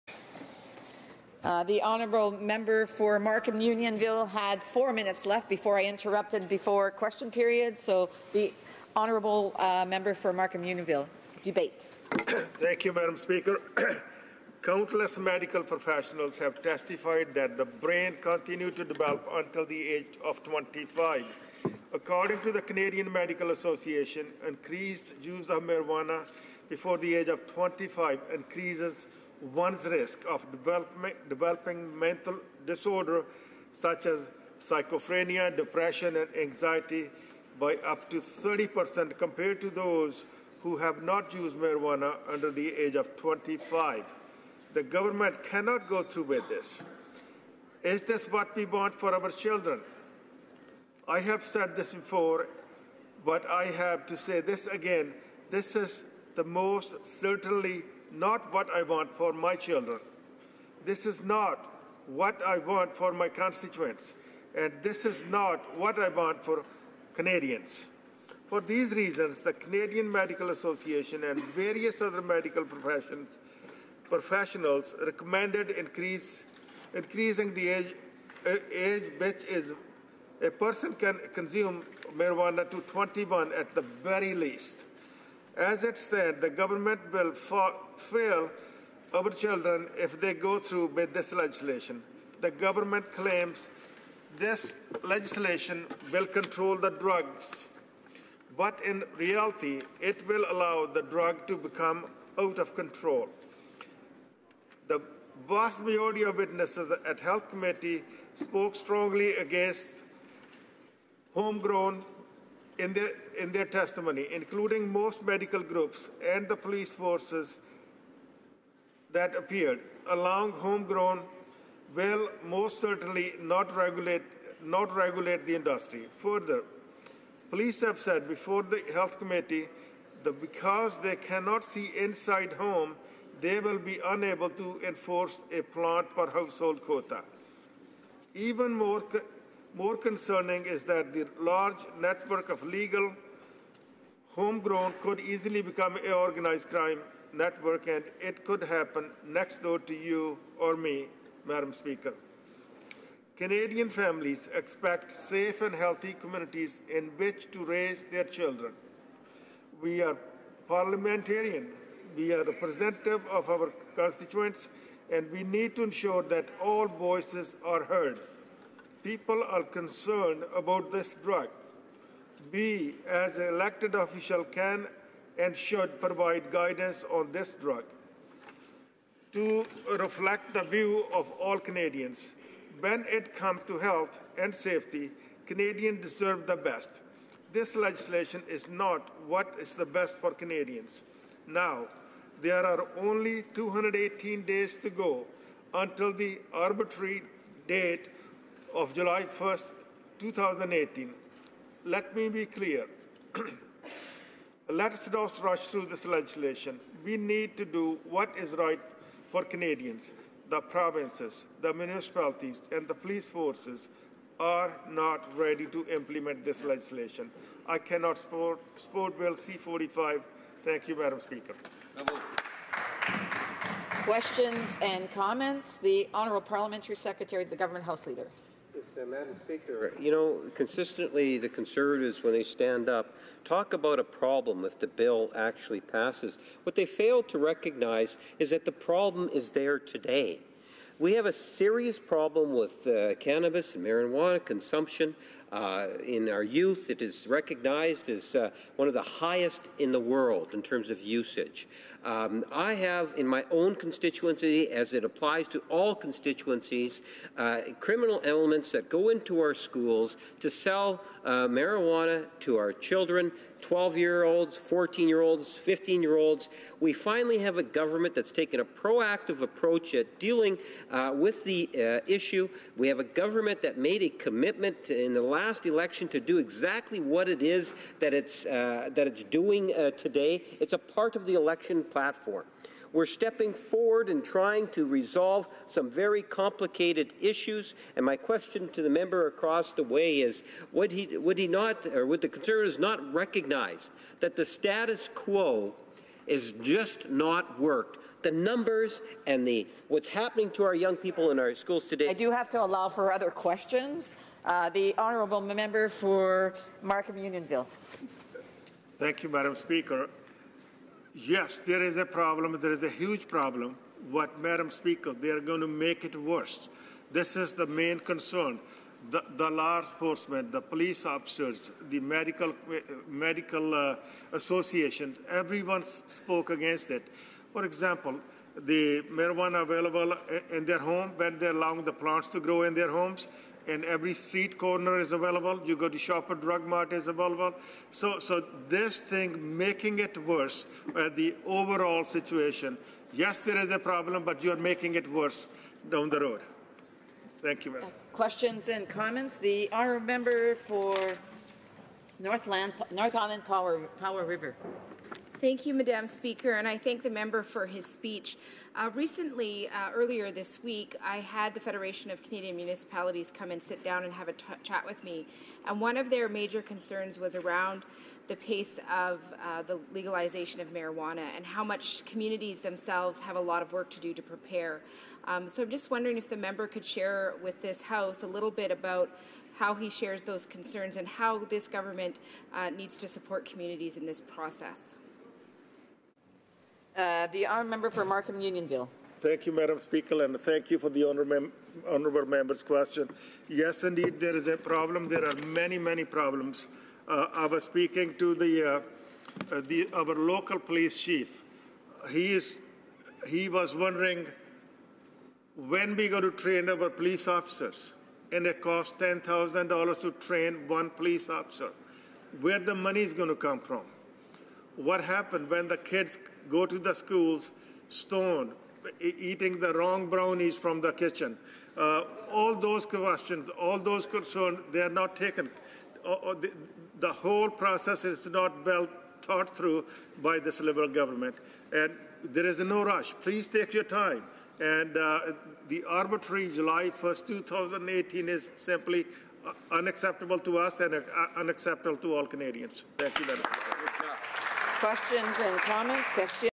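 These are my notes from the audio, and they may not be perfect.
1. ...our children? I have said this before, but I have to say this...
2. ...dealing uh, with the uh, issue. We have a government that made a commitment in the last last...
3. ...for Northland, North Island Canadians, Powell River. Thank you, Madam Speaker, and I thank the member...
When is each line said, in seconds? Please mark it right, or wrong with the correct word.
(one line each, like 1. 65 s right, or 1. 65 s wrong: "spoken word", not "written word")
1. 49 s right
2. 270 s right
3. 350 s wrong: "Powell", not "Canadians".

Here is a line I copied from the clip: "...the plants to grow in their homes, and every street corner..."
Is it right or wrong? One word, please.
right.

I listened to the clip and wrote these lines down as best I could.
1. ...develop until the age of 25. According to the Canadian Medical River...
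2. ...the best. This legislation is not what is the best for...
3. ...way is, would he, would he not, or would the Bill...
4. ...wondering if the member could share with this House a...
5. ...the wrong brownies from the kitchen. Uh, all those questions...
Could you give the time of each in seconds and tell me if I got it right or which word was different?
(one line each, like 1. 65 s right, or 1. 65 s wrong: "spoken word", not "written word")
1. 18 s wrong: "Association", not "River"
2. 186 s right
3. 289 s wrong: "Conservatives", not "Bill"
4. 375 s right
5. 419 s right.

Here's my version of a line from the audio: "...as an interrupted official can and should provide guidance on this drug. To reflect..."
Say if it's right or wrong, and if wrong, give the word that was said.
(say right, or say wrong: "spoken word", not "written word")
wrong: "elected", not "interrupted".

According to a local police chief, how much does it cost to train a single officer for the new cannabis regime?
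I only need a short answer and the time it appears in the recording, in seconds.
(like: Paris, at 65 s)
$10,000, at 408 s.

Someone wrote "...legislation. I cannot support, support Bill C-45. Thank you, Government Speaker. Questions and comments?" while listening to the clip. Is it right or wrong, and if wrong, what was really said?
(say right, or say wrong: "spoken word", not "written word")
wrong: "Madam", not "Government".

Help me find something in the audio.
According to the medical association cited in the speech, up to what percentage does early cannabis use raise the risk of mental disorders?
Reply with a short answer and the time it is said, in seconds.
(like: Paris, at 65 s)
30%, at 38 s.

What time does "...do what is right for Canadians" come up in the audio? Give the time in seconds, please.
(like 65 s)
207 s.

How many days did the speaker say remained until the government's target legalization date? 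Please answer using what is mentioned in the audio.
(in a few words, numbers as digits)
218.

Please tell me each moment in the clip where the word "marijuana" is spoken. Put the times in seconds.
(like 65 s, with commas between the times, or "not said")
25 s, 41 s, 82 s, 243 s, 261 s, 329 s, 370 s.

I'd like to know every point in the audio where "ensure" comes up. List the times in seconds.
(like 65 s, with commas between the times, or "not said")
165 s.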